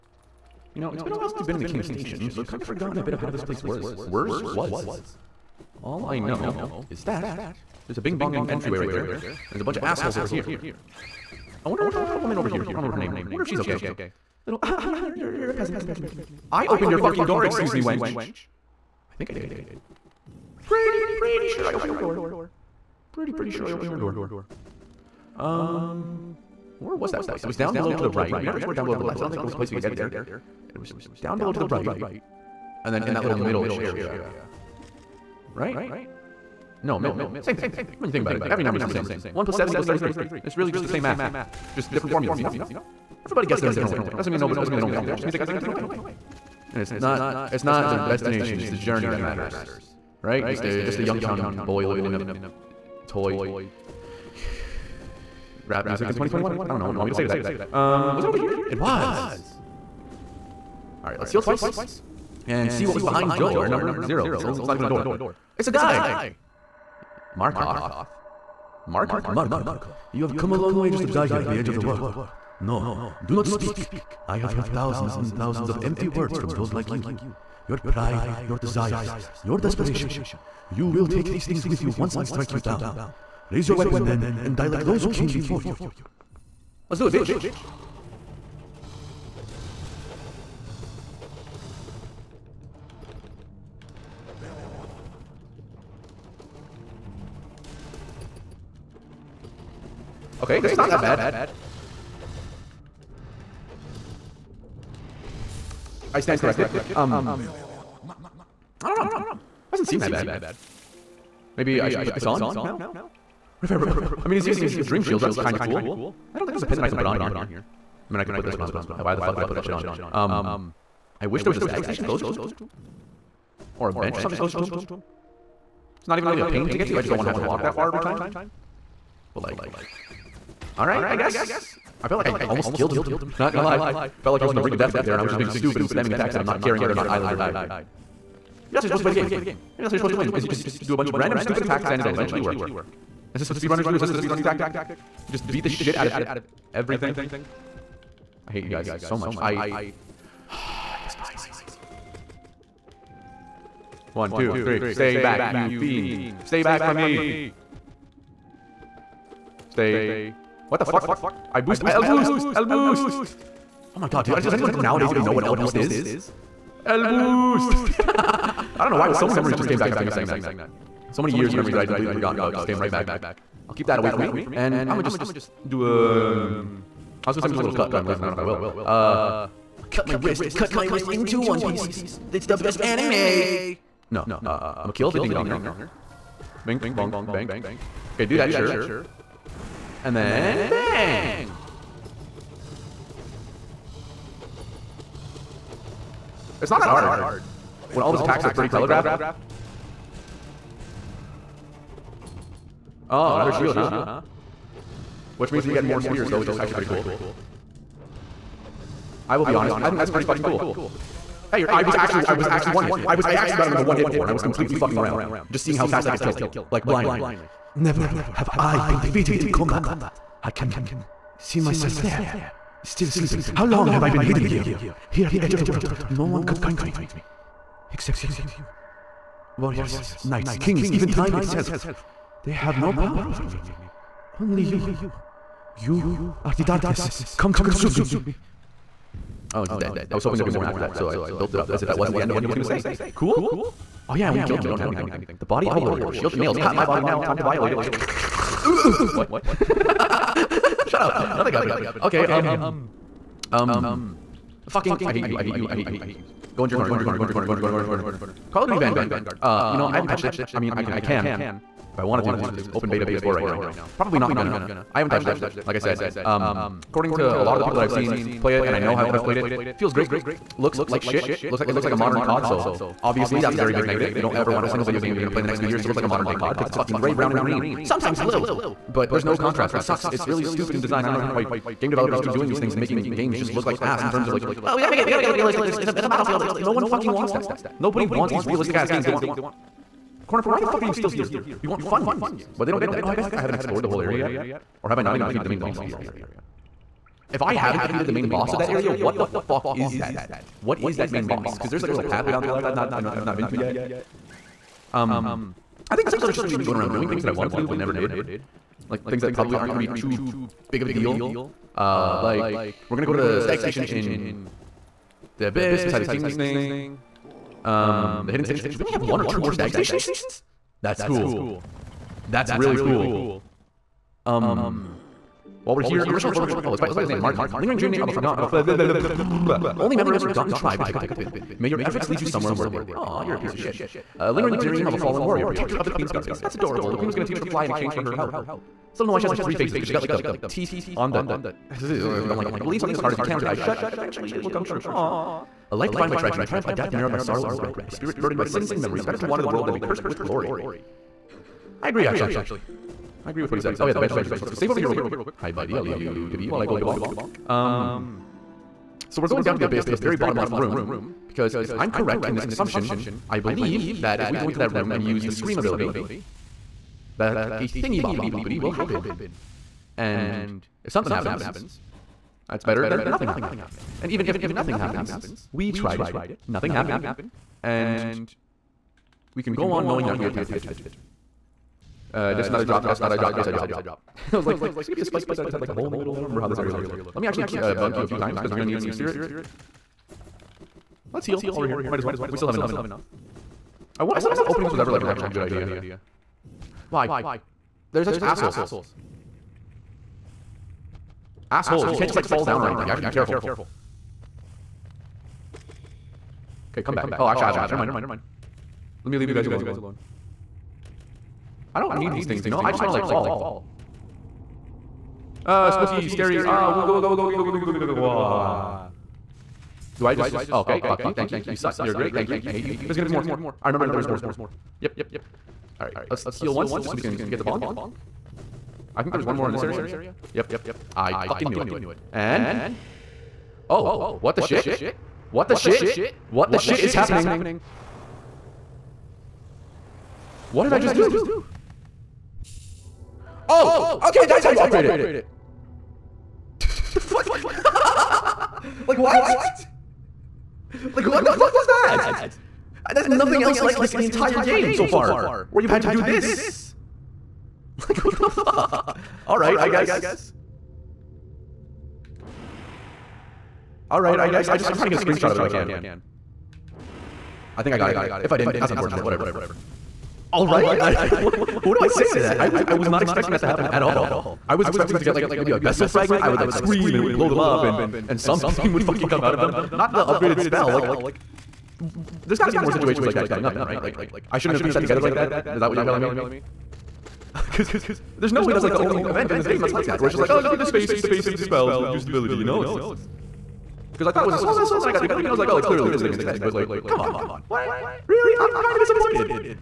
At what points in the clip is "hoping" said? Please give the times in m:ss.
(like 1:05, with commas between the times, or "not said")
4:00.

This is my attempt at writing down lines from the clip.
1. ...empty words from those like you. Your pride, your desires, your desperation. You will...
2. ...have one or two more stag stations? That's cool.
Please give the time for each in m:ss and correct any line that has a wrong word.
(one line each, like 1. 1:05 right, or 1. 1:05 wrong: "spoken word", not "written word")
1. 1:15 right
2. 5:18 right.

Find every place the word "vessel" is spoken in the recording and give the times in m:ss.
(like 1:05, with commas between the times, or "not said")
7:55, 8:14.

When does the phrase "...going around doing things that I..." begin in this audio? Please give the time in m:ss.
5:06.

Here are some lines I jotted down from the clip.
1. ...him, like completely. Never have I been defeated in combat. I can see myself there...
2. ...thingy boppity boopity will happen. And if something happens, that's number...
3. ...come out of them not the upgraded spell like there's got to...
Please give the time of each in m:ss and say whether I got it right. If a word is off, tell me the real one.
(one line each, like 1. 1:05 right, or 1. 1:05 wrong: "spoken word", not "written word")
1. 3:36 wrong: "blindly", not "completely"
2. 6:07 wrong: "better", not "number"
3. 7:59 right.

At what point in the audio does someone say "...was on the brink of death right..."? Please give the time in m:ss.
2:14.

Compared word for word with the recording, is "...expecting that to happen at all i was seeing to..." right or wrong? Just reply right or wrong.
wrong.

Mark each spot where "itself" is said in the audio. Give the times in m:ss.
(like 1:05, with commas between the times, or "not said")
3:51.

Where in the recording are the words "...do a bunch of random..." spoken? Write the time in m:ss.
2:20.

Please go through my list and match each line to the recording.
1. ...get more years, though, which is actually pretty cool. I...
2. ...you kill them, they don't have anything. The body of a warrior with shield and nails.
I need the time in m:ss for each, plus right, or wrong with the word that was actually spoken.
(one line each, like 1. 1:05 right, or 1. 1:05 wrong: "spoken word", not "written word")
1. 3:25 wrong: "spears", not "years"
2. 4:04 right.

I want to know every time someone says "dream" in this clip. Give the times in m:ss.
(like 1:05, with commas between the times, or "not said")
1:54, 5:27, 5:34.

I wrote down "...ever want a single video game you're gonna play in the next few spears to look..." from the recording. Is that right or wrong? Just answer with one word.
wrong.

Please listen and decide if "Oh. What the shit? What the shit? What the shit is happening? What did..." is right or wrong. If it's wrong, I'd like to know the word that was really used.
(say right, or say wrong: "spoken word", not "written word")
right.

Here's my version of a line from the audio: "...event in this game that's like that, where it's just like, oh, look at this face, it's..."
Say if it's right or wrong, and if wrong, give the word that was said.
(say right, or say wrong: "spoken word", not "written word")
right.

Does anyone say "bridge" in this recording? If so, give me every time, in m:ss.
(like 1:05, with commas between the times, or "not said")
not said.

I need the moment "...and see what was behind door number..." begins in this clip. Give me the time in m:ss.
1:02.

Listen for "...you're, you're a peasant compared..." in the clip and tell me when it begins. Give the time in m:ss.
0:15.